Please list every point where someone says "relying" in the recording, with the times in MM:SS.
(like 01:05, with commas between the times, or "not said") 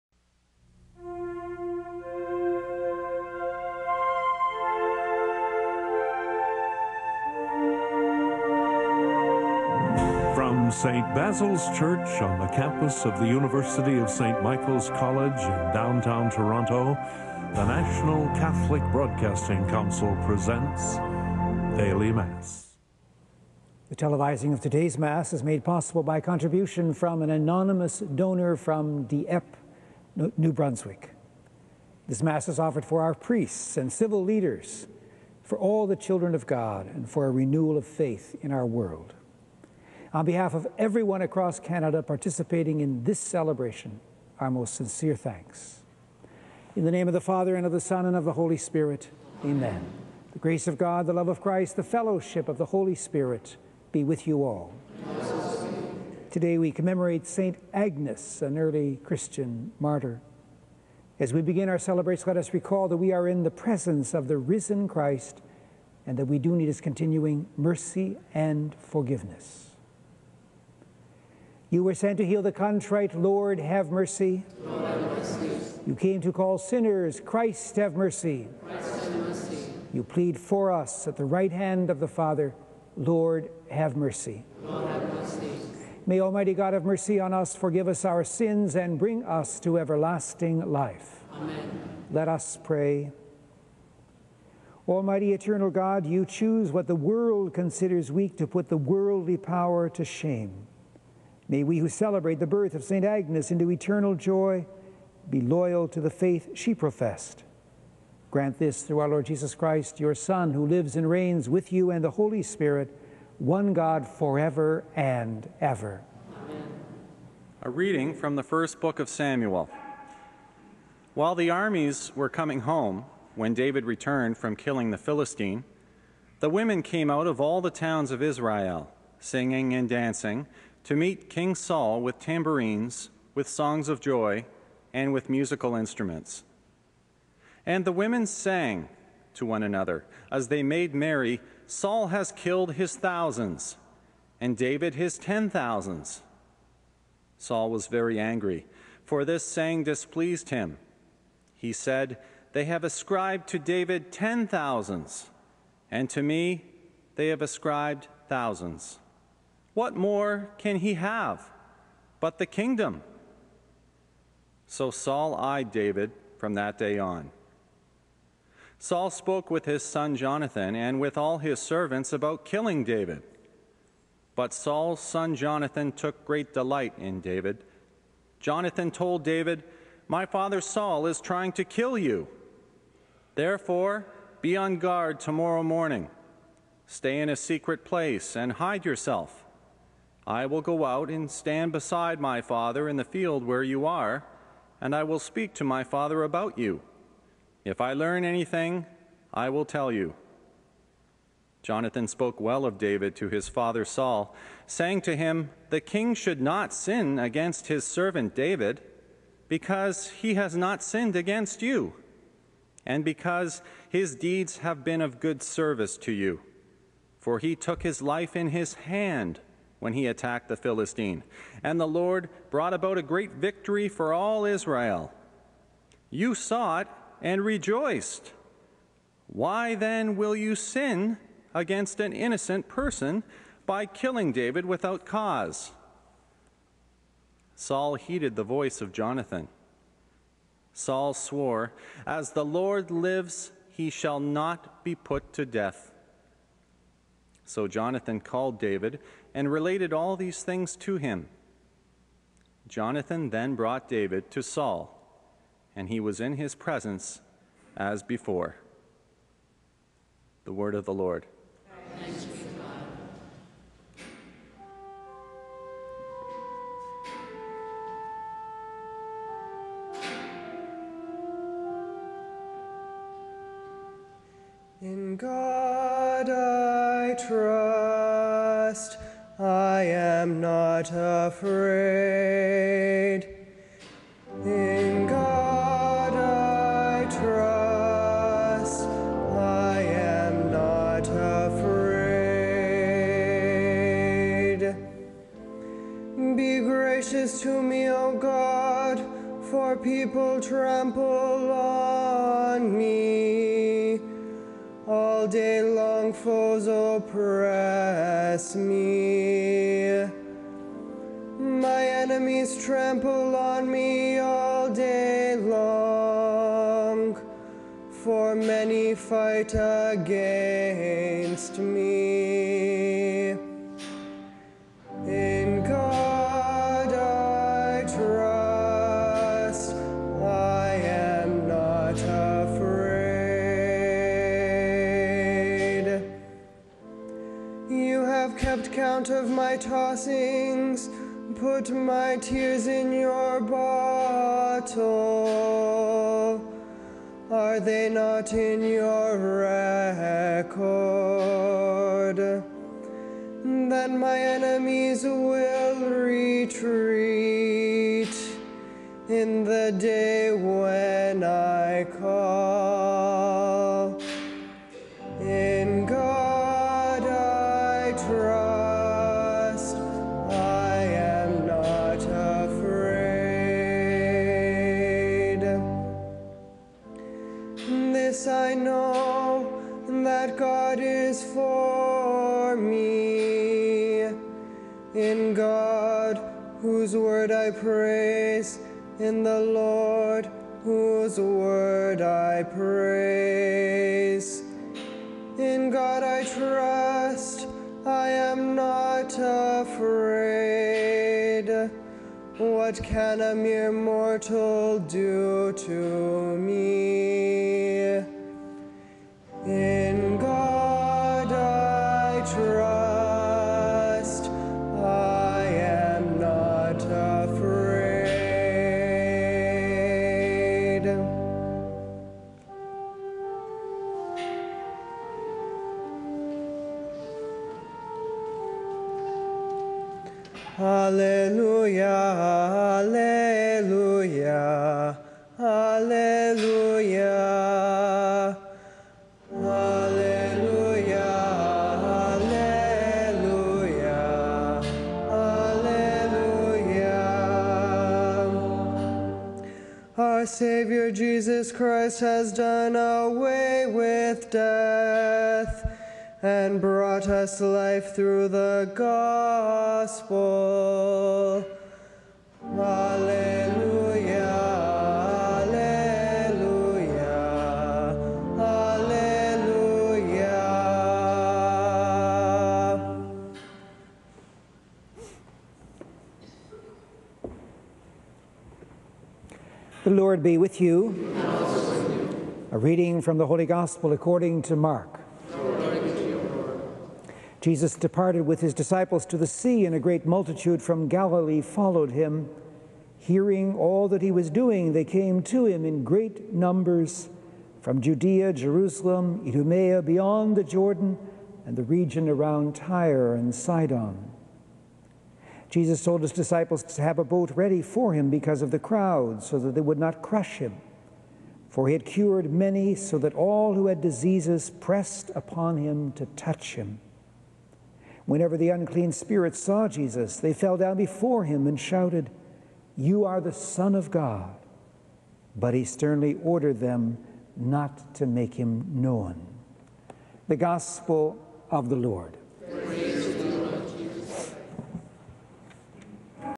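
not said.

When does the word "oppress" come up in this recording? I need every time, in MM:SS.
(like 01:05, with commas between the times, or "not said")
05:06.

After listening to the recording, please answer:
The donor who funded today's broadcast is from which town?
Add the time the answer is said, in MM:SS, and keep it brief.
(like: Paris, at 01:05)
Dieppe, New Brunswick, at 00:29.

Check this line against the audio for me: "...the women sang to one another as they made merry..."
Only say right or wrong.
right.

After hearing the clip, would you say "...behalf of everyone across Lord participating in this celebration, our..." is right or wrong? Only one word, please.
wrong.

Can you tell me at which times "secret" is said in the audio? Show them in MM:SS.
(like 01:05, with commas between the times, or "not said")
03:07.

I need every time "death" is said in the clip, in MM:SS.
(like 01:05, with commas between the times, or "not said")
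04:05, 07:34.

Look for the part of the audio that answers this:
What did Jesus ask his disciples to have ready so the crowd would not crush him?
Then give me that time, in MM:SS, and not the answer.
08:27.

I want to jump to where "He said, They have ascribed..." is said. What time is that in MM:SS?
02:31.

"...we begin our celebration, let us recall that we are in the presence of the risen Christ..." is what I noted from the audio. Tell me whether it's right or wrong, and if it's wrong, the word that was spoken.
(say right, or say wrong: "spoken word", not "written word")
right.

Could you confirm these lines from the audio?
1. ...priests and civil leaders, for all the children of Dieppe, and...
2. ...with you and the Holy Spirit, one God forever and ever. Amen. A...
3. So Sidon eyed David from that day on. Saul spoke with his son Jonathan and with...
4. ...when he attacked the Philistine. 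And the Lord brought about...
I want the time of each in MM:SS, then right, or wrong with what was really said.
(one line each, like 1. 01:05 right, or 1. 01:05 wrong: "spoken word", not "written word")
1. 00:33 wrong: "God", not "Dieppe"
2. 01:51 right
3. 02:44 wrong: "Saul", not "Sidon"
4. 03:39 right.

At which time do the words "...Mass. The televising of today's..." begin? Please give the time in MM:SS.
00:22.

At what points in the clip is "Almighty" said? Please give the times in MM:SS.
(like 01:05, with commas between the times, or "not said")
01:26, 01:34.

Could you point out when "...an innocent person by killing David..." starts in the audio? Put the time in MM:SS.
03:51.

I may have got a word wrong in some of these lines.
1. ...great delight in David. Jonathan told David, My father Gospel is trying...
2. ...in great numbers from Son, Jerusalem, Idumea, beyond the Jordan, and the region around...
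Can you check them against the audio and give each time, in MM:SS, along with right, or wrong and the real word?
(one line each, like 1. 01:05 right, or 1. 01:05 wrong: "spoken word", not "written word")
1. 02:56 wrong: "Saul", not "Gospel"
2. 08:15 wrong: "Judea", not "Son".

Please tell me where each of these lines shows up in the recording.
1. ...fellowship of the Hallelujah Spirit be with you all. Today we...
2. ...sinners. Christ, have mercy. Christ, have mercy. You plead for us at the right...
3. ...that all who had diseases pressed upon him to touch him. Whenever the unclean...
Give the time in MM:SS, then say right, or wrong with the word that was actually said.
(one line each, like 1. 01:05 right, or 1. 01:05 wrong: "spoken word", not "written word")
1. 00:51 wrong: "Holy", not "Hallelujah"
2. 01:16 right
3. 08:32 right.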